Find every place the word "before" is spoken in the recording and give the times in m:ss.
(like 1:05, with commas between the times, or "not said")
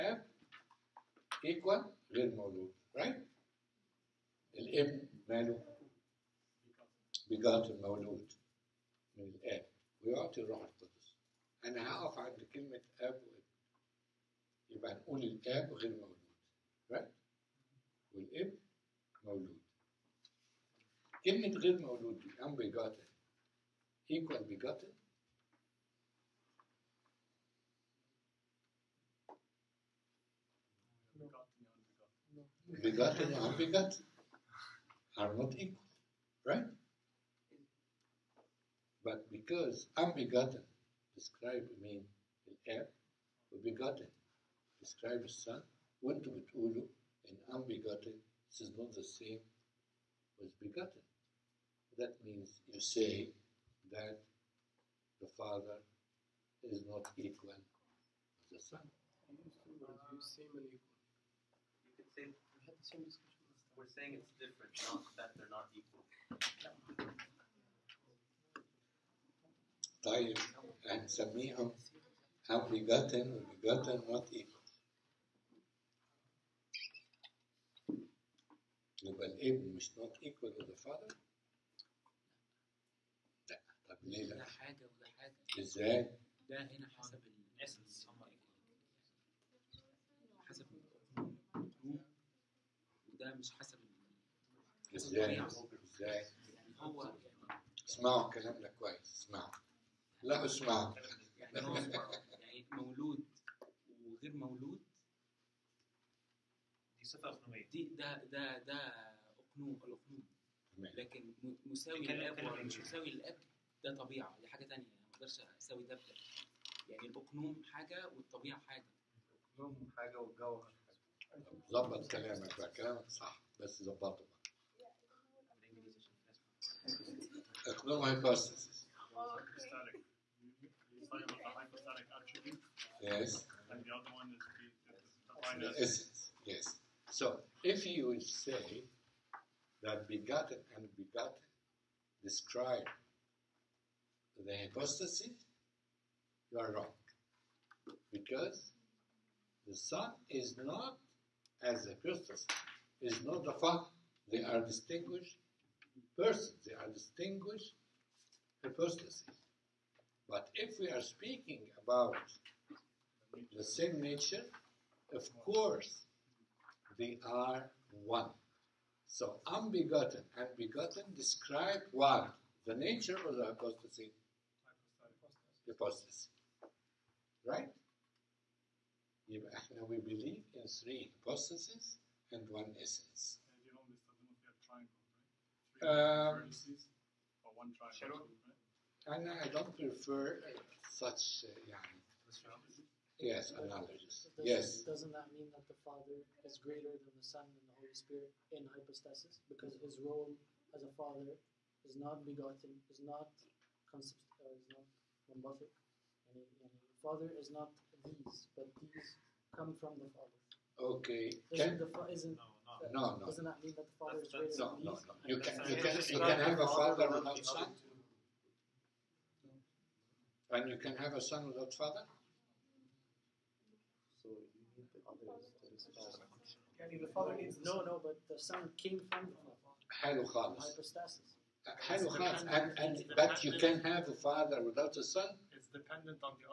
not said.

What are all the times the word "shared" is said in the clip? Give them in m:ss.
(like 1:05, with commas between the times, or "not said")
not said.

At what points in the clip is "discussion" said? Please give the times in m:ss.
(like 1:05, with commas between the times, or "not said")
1:03.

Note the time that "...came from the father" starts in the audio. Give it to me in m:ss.
3:48.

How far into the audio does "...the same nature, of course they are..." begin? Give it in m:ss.
2:43.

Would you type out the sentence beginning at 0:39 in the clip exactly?
But because unbegotten describes mean the heir, begotten describes son, to be ulu, and unbegotten this is not the same as begotten.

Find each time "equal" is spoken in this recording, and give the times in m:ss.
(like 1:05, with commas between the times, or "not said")
0:35, 0:57, 1:05, 1:14, 1:20.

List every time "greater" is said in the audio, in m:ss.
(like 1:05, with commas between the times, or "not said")
3:16, 3:34.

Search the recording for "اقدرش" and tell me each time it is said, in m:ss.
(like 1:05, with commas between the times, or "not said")
1:55.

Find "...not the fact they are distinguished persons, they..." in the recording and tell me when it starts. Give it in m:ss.
2:33.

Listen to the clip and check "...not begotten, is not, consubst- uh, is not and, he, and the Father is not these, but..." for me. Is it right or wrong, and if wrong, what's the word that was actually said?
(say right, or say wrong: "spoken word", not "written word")
right.